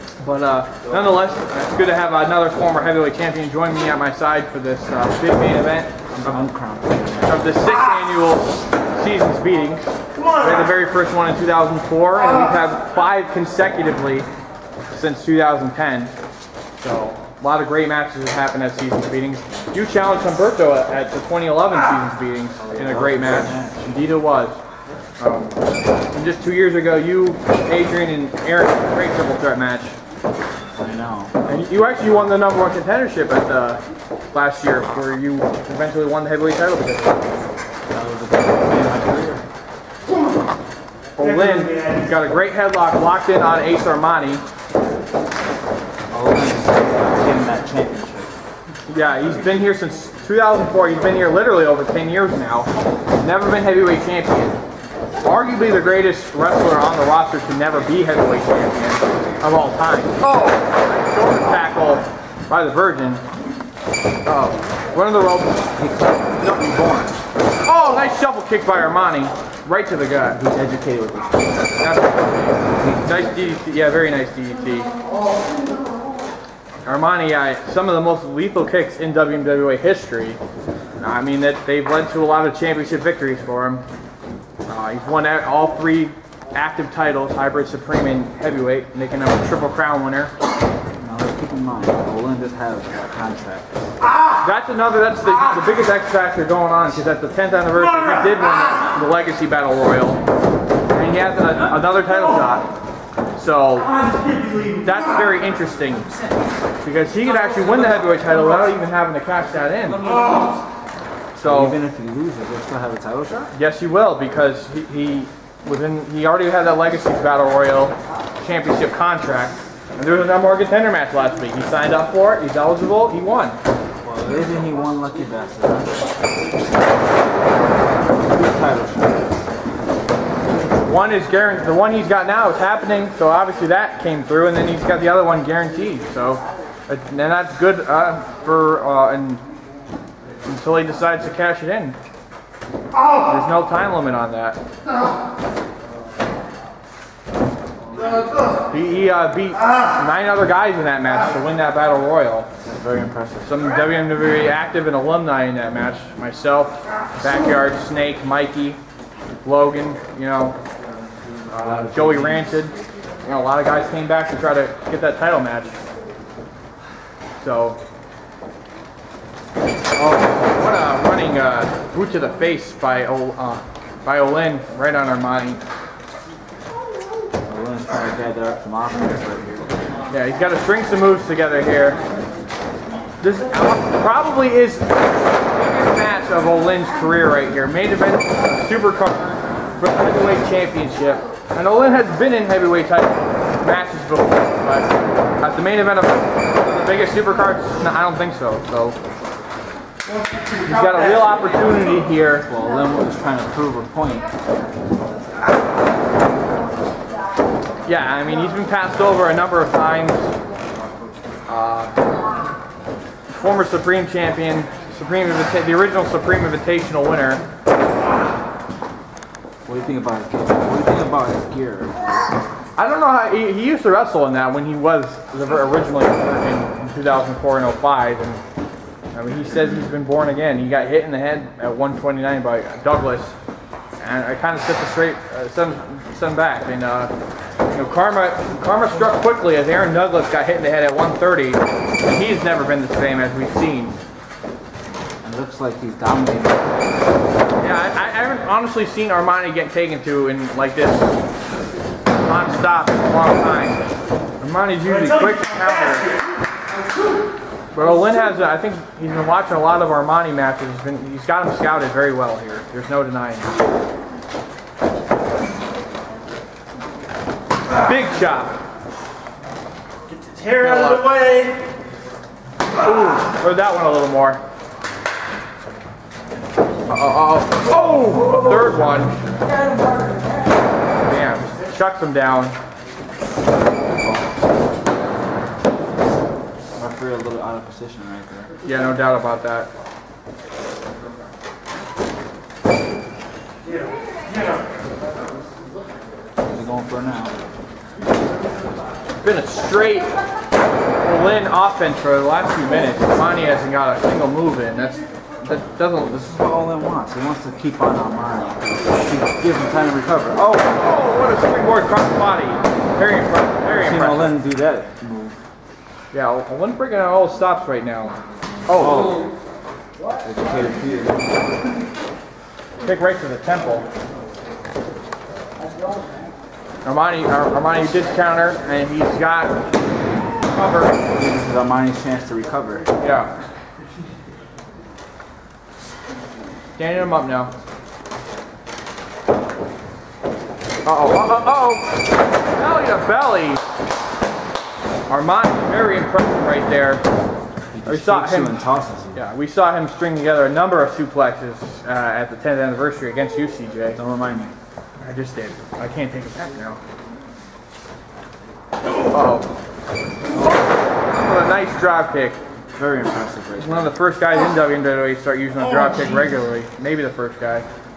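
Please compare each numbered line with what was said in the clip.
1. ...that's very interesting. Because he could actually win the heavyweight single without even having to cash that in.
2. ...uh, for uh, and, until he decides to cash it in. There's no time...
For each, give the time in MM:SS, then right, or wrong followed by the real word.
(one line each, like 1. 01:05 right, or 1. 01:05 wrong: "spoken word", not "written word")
1. 01:44 wrong: "title", not "single"
2. 02:17 right.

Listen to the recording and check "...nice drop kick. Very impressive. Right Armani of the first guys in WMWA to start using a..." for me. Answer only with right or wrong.
wrong.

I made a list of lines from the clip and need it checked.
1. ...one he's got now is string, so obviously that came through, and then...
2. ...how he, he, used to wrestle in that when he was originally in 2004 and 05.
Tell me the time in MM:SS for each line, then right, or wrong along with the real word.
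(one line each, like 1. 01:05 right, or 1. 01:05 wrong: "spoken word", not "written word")
1. 02:11 wrong: "happening", not "string"
2. 03:43 right.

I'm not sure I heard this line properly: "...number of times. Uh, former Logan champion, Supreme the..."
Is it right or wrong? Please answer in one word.
wrong.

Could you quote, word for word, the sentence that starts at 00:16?
So a lot of great matches have happened at Seasons Beatings.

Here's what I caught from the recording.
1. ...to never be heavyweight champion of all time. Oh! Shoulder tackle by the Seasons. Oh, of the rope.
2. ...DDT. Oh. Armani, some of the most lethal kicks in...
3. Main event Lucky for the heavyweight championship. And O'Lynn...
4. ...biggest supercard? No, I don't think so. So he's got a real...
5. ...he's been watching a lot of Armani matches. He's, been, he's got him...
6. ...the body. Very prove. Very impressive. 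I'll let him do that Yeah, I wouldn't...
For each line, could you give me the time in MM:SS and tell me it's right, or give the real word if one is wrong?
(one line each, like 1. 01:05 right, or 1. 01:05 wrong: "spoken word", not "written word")
1. 00:57 wrong: "Virgin", not "Seasons"
2. 01:14 right
3. 03:07 wrong: "Super", not "Lucky"
4. 03:16 right
5. 04:19 right
6. 05:11 wrong: "impressive", not "prove".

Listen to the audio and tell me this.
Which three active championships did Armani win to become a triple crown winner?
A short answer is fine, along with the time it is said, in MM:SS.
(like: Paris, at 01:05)
hybrid, supreme, and heavyweight, at 01:27.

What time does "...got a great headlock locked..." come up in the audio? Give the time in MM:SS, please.
00:42.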